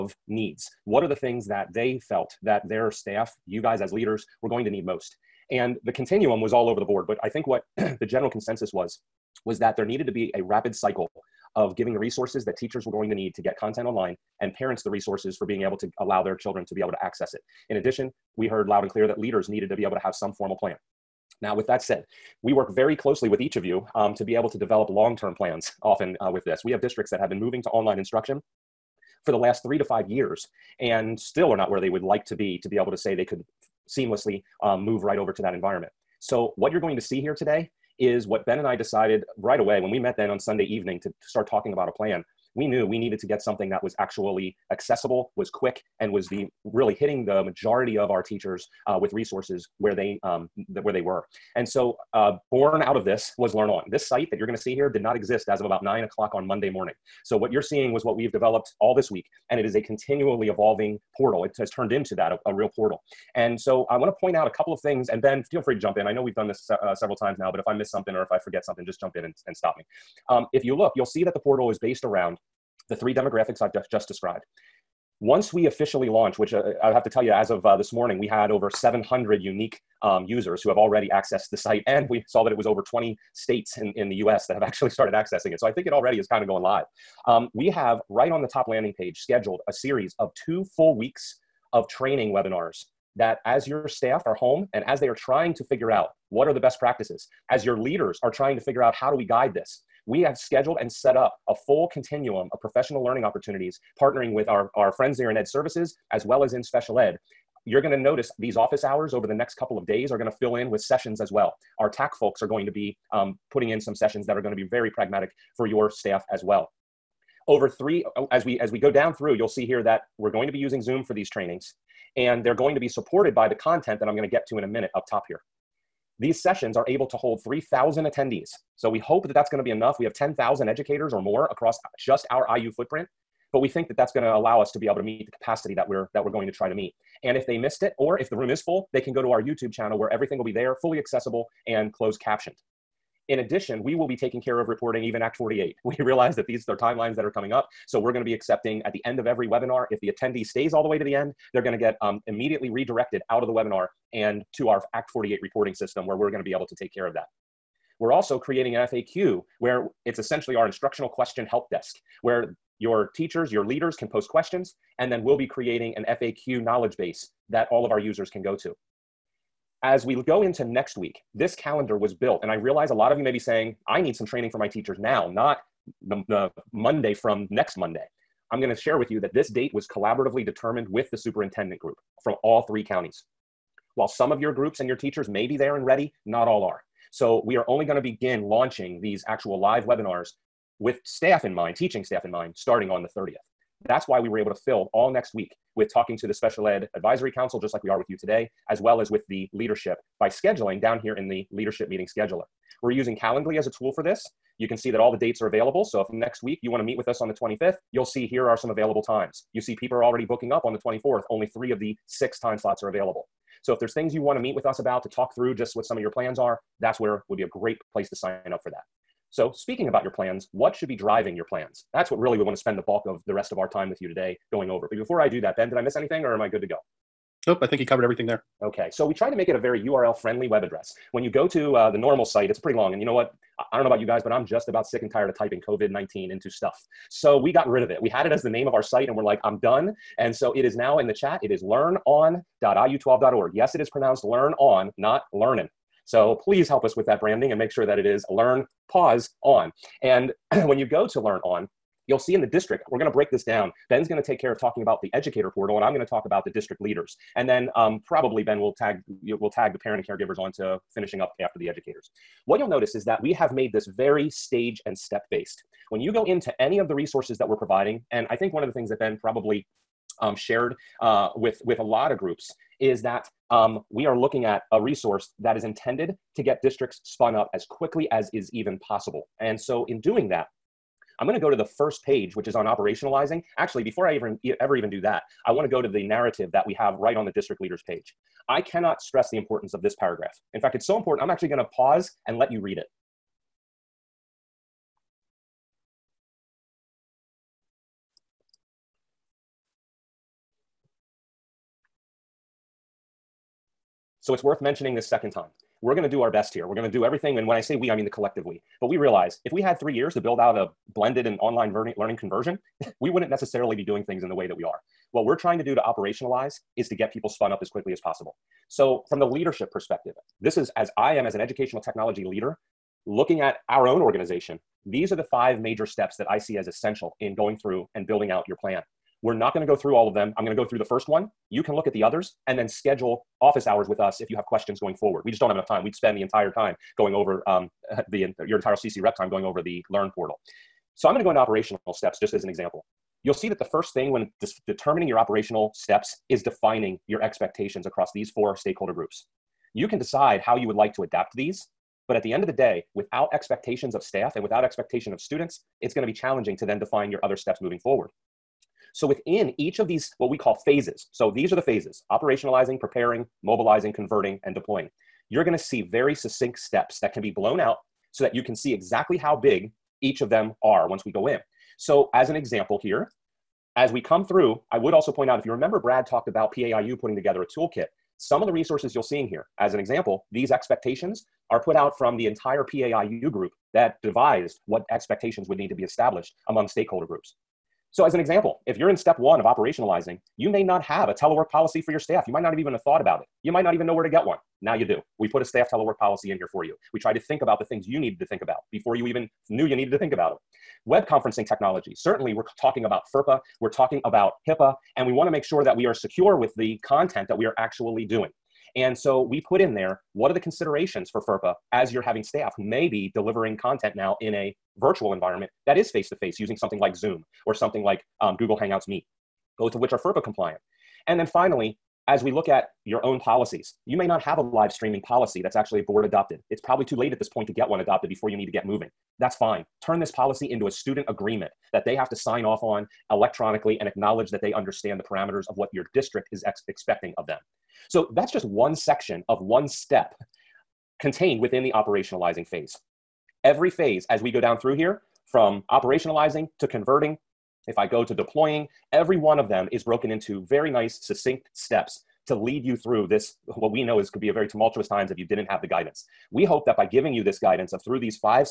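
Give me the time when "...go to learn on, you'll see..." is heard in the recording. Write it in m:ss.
4:10.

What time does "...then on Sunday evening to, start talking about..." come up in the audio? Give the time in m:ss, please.
0:40.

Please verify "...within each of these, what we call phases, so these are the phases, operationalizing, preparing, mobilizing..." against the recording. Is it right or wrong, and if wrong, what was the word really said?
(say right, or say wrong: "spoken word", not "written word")
right.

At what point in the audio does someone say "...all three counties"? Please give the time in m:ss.
3:02.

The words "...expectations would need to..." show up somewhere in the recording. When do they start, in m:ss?
6:24.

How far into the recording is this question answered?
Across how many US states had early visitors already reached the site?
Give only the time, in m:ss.
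1:22.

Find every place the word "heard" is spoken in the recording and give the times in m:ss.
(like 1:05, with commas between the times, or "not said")
0:18.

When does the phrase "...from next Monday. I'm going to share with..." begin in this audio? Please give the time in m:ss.
2:57.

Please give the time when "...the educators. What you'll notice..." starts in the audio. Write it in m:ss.
4:21.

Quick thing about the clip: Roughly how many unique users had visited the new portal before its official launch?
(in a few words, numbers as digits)
700.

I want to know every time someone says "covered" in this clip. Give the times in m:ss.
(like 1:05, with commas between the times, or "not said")
3:47.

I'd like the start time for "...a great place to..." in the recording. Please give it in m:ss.
3:37.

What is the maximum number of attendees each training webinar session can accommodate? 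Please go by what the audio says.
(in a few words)
3,000.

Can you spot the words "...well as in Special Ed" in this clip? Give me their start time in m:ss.
1:46.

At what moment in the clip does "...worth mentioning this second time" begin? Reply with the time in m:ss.
5:04.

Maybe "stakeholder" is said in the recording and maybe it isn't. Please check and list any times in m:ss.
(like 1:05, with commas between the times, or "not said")
5:48, 6:26.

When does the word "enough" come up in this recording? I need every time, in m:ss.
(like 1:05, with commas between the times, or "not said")
2:09, 5:35.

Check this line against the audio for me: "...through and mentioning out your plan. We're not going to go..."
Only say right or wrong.
wrong.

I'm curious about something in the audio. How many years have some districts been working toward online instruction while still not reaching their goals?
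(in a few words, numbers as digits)
3 to 5.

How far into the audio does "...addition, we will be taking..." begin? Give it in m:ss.
2:23.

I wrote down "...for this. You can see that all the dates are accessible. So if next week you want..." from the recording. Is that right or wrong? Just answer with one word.
wrong.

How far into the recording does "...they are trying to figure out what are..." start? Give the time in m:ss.
1:35.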